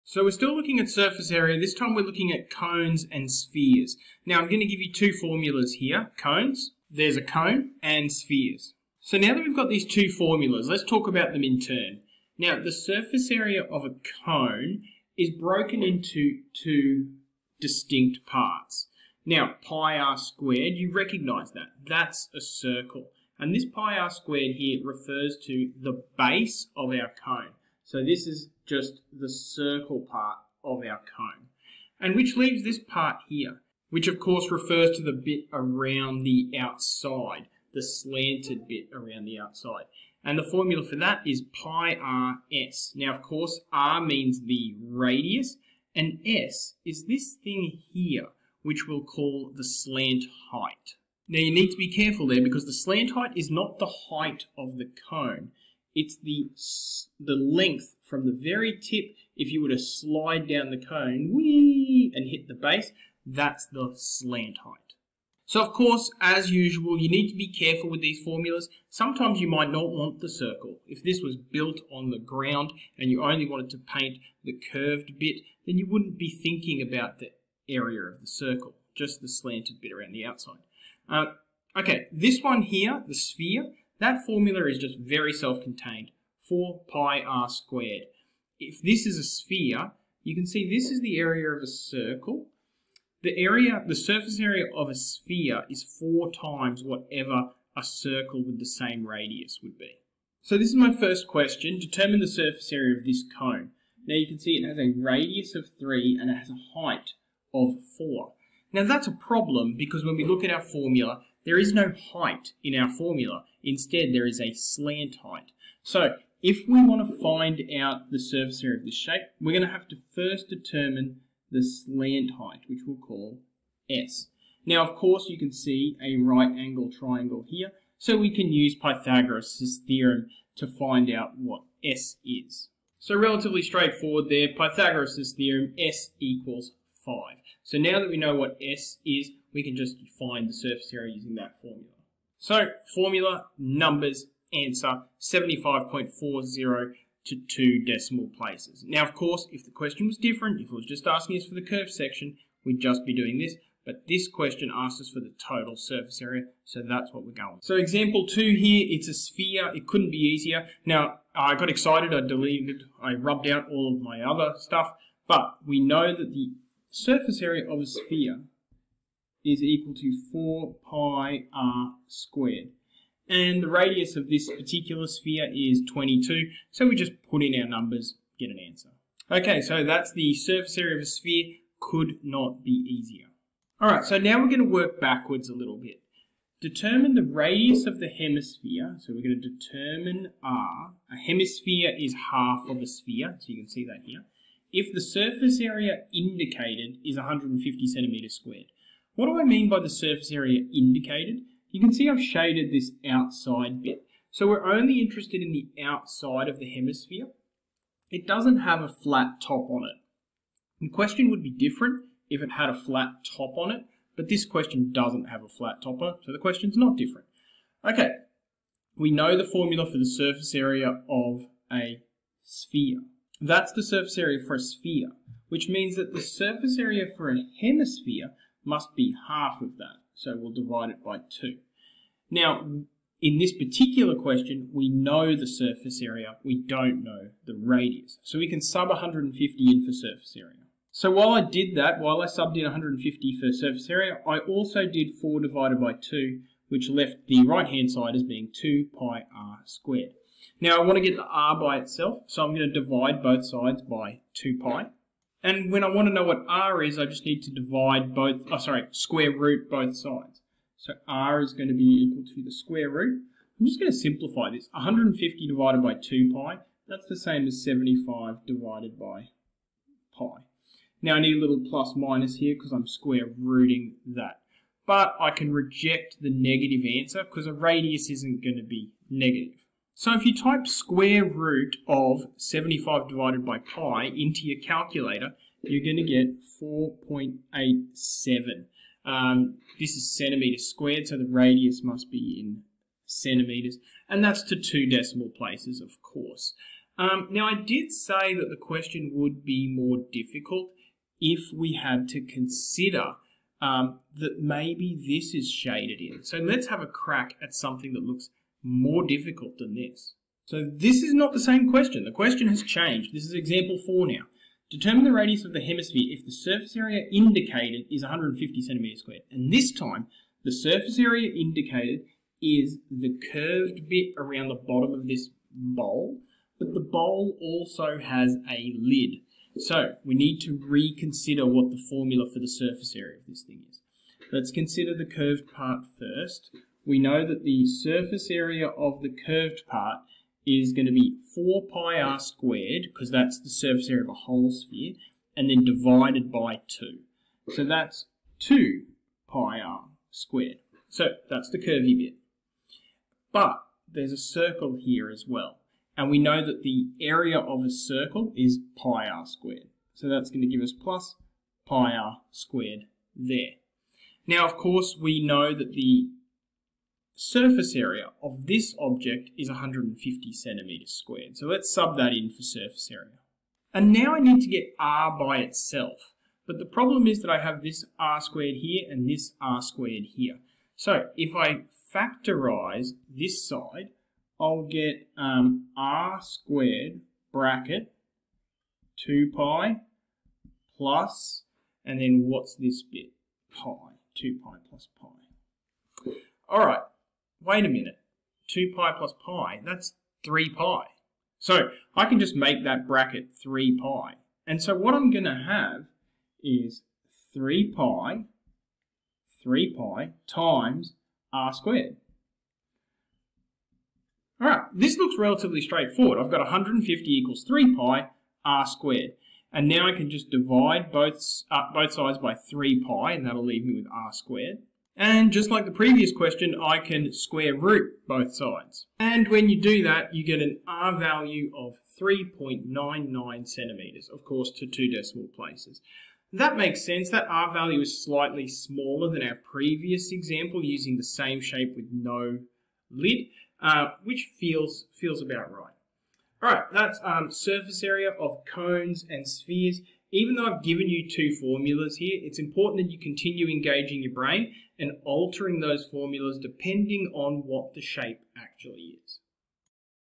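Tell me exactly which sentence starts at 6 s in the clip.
Cones, there's a cone, and spheres.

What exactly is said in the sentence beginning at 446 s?
All right, that's um, surface area of cones and spheres.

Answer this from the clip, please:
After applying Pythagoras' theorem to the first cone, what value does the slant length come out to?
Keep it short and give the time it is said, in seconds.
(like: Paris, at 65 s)
5, at 135 s.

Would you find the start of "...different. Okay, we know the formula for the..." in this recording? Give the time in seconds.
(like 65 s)
216 s.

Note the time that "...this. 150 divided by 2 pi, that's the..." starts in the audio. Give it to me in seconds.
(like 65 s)
264 s.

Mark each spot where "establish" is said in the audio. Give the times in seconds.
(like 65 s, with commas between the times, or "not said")
not said.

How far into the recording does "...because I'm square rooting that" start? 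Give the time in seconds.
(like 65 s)
272 s.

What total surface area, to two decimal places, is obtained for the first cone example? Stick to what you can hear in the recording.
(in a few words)
75.40.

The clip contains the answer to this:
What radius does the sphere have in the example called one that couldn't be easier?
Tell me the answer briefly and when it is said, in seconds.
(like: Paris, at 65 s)
22, at 175 s.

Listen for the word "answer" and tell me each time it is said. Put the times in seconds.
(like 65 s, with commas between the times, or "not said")
144 s, 178 s, 277 s.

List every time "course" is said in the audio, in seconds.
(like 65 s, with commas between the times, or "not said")
34 s, 43 s, 65 s, 124 s, 149 s, 296 s, 364 s, 434 s.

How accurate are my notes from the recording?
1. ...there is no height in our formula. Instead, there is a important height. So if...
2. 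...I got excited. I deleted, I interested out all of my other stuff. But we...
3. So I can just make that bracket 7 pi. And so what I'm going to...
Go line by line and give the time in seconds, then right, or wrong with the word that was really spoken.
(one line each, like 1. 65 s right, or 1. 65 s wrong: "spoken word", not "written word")
1. 111 s wrong: "slant", not "important"
2. 161 s wrong: "rubbed", not "interested"
3. 401 s wrong: "3", not "7".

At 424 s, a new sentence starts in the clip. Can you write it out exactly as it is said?
And just like the previous question, I can square root both sides.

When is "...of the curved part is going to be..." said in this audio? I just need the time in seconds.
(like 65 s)
338 s.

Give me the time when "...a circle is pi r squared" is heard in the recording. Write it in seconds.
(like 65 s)
357 s.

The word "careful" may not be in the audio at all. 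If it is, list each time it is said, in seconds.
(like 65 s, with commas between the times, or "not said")
51 s, 67 s.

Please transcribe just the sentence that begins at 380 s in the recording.
So if I factorize this side, I'll get um, r squared bracket 2 pi plus, and then what's this bit?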